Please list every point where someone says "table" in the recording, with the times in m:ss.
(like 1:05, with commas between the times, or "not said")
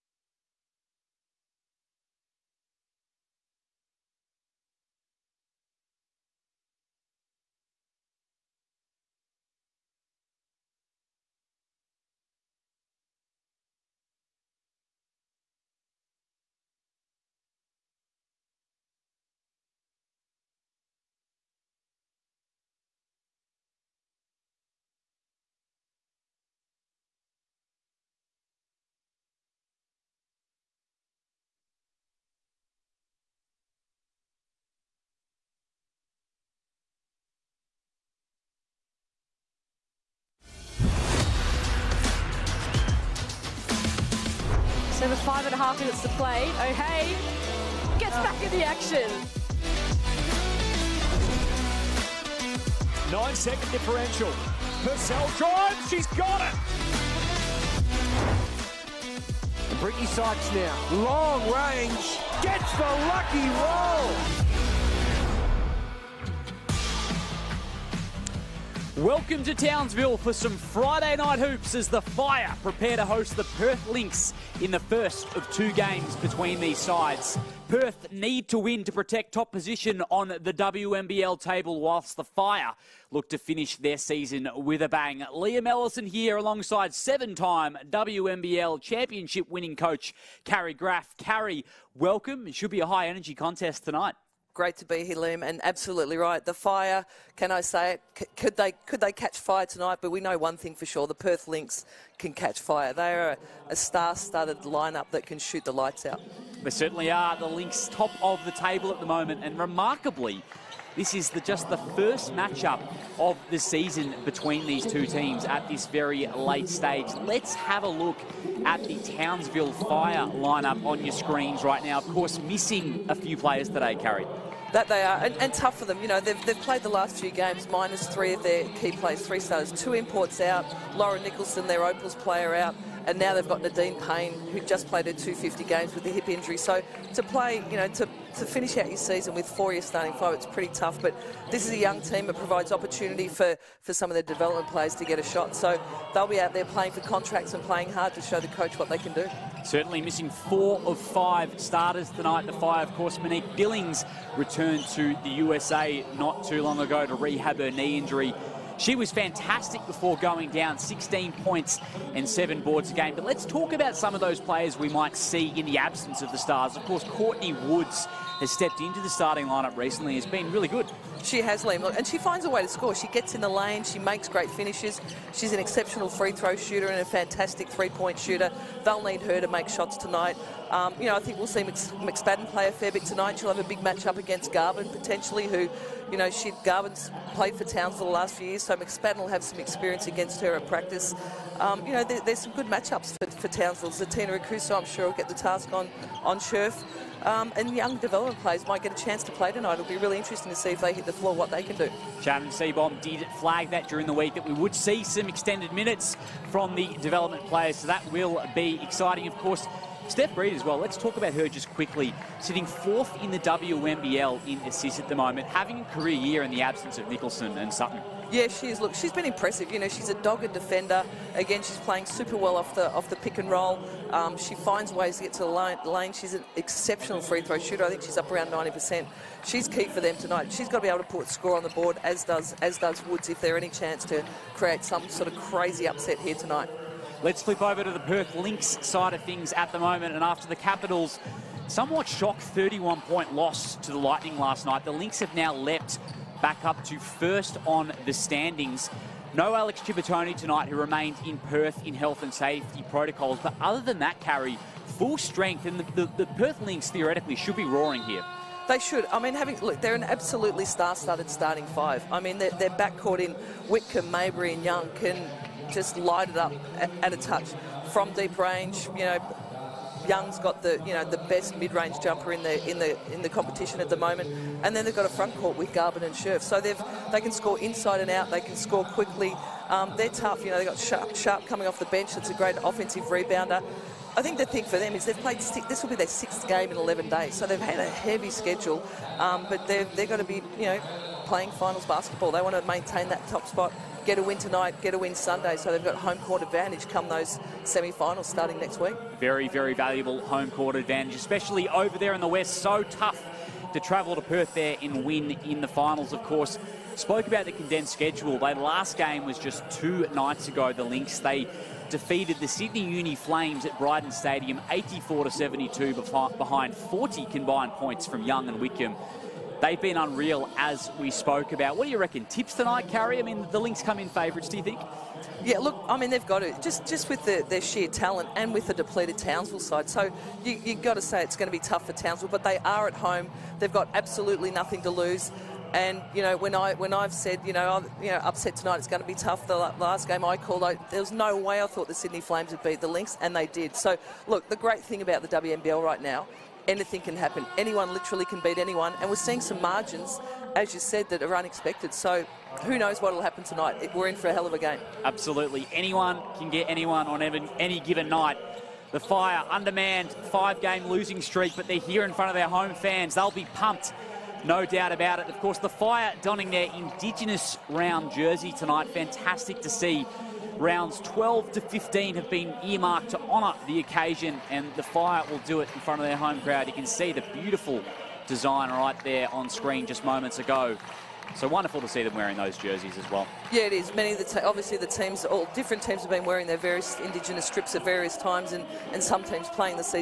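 1:21, 1:48.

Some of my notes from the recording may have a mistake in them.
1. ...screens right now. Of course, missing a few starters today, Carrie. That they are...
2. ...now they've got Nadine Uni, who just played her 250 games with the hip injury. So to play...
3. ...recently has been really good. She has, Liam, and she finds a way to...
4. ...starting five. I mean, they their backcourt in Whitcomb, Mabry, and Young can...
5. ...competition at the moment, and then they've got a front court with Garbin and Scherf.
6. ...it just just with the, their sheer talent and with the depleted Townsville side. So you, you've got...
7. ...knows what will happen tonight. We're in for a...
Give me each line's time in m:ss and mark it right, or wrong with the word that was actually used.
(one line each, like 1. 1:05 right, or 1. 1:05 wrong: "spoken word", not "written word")
1. 2:01 wrong: "players", not "starters"
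2. 2:13 wrong: "Payne", not "Uni"
3. 2:49 right
4. 4:21 right
5. 4:33 right
6. 5:26 right
7. 5:52 right.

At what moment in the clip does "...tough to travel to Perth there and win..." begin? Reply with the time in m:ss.
5:02.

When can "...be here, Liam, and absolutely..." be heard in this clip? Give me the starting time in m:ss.
1:34.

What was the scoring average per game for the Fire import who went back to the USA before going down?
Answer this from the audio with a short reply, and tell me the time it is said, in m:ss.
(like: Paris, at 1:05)
16 points, at 2:40.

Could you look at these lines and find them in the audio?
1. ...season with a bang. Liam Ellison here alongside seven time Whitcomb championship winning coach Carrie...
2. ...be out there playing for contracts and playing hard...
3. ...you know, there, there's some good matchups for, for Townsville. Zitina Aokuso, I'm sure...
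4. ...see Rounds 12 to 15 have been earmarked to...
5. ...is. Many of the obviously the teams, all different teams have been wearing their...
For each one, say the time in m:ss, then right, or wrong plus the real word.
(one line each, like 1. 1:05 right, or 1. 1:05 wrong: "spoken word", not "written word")
1. 1:23 wrong: "WNBL", not "Whitcomb"
2. 2:26 right
3. 3:11 right
4. 6:09 right
5. 6:23 right.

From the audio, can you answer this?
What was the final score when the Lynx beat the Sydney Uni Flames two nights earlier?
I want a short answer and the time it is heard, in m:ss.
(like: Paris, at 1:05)
84 to 72, at 5:14.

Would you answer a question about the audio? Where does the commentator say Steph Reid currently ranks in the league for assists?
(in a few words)
fourth.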